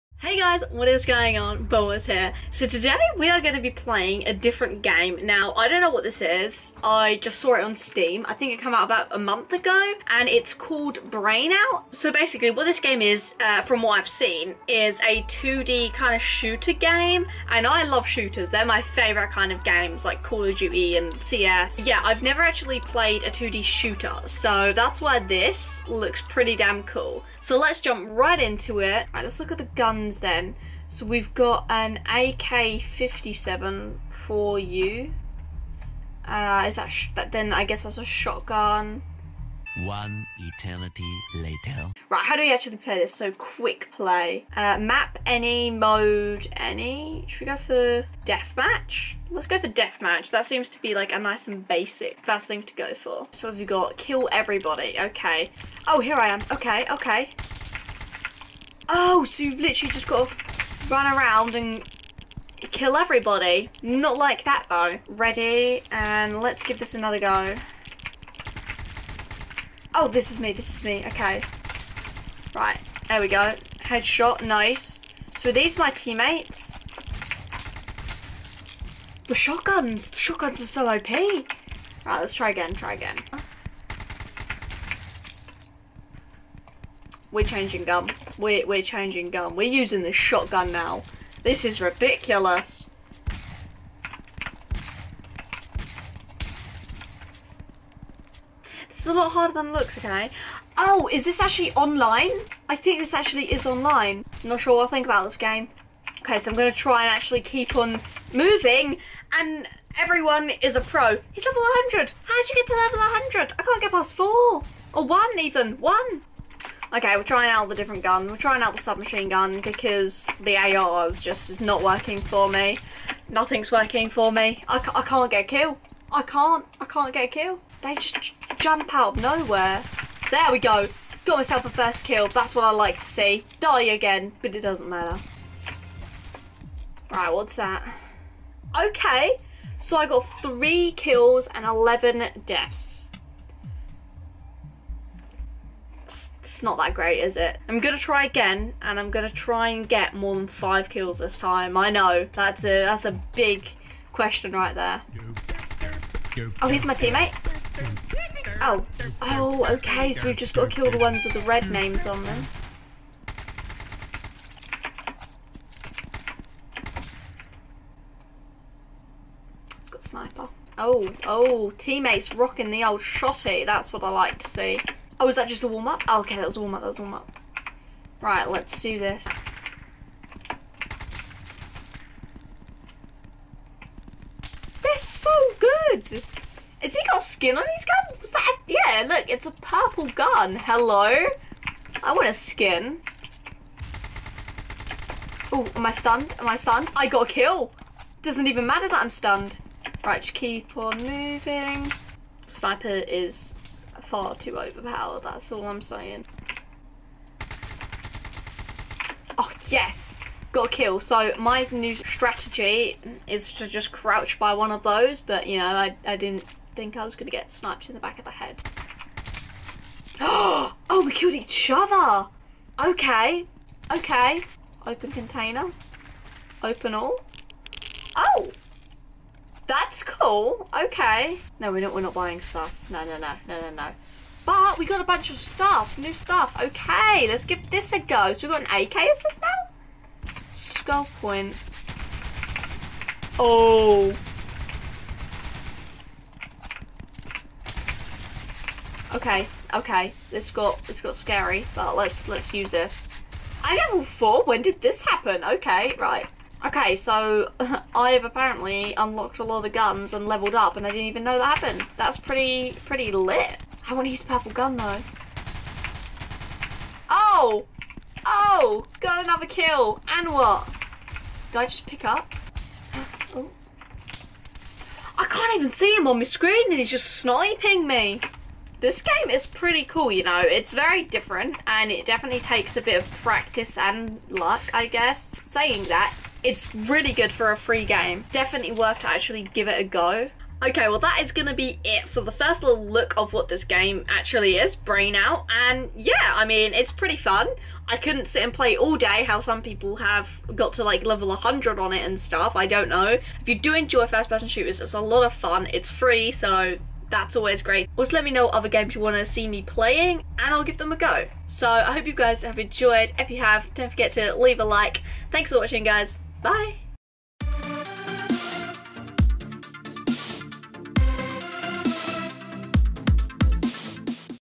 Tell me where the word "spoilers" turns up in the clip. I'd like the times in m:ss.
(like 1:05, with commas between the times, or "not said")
not said.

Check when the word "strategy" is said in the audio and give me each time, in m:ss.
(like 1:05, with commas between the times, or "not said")
3:31.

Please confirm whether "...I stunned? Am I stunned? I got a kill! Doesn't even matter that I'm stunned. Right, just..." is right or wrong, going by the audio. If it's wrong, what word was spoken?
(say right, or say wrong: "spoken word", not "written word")
right.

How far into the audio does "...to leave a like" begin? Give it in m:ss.
5:14.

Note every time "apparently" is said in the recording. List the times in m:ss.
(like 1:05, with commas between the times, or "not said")
4:18.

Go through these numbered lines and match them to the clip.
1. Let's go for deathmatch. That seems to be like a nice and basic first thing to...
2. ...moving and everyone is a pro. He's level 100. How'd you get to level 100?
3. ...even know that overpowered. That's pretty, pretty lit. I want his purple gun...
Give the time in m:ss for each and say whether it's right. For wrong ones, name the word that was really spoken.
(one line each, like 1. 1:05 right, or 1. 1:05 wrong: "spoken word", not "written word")
1. 0:49 right
2. 1:48 right
3. 4:21 wrong: "happened", not "overpowered".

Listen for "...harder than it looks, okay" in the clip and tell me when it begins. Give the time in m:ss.
1:39.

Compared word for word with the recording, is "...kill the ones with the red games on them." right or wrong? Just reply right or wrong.
wrong.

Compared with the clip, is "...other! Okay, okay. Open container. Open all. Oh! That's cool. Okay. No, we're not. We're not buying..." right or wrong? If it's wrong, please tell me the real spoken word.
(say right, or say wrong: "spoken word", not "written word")
right.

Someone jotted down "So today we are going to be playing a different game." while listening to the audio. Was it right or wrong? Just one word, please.
right.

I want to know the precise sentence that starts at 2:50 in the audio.
Oh, oh, teammates rocking the old shotty.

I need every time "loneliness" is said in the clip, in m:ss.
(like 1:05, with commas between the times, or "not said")
not said.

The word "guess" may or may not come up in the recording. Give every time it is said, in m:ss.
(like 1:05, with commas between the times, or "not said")
0:37, 4:44.